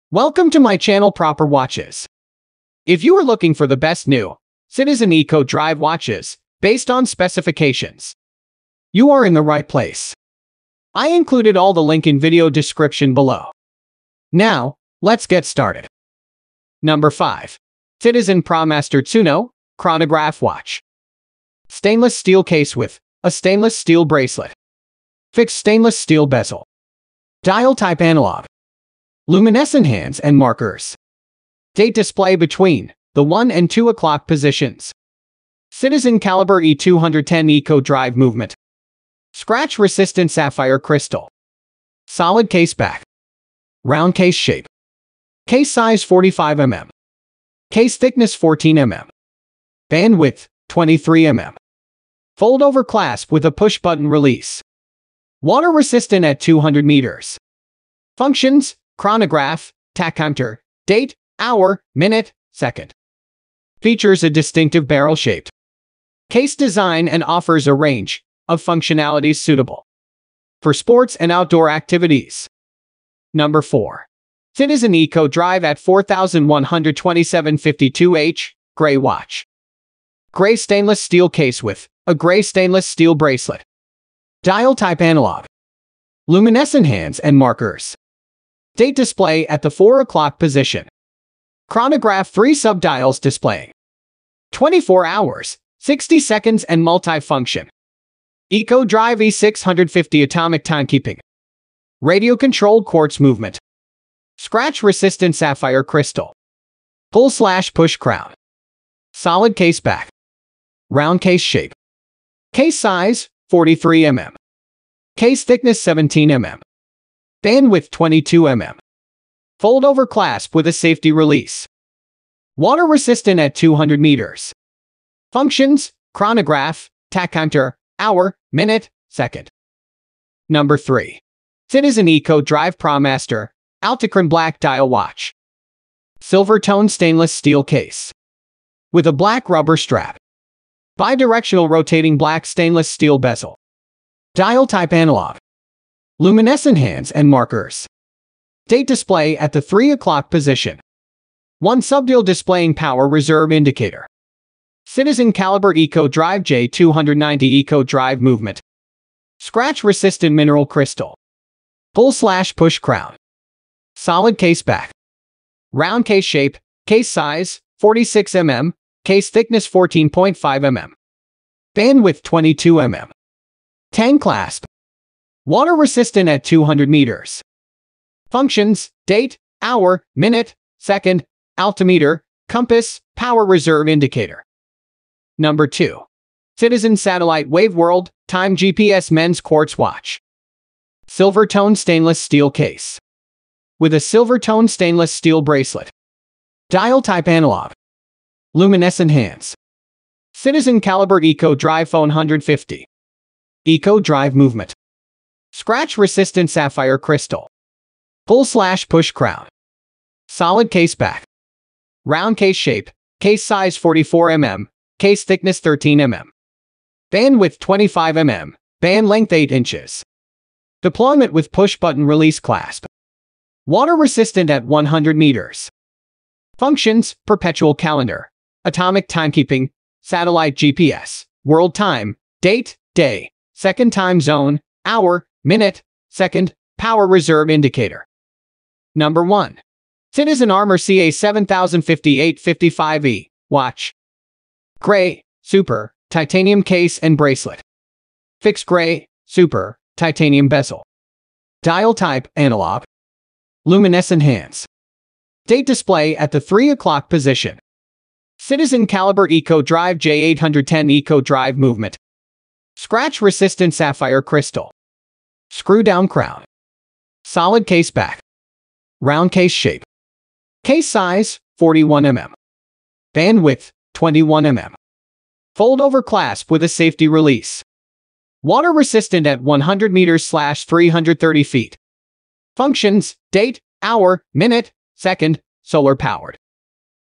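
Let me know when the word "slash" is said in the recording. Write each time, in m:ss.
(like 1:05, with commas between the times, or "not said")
1:47, 2:42, 3:28, 4:40.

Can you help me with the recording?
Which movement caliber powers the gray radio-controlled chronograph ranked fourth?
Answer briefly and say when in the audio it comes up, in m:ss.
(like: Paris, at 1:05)
E650, at 1:38.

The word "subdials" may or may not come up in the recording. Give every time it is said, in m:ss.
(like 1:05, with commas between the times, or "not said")
1:32, 2:31.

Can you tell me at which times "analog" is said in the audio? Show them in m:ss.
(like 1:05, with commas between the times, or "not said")
0:28, 1:25, 2:24, 3:17, 4:12.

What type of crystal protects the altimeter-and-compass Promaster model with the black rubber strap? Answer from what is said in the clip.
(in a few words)
Mineral crystal.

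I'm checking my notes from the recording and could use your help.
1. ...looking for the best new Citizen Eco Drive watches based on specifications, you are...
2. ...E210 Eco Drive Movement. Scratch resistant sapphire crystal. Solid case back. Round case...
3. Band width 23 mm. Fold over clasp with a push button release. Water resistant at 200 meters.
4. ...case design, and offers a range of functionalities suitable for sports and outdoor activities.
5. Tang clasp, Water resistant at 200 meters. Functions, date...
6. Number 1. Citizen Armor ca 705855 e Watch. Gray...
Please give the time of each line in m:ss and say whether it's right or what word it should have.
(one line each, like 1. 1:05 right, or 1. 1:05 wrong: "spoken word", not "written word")
1. 0:03 right
2. 0:36 right
3. 0:49 right
4. 1:06 right
5. 2:53 right
6. 3:58 right.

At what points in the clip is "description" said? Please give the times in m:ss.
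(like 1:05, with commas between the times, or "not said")
0:12.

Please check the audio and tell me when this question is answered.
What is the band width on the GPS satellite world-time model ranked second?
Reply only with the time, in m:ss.
3:37.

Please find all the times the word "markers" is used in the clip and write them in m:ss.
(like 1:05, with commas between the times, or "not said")
0:30, 1:27, 2:27.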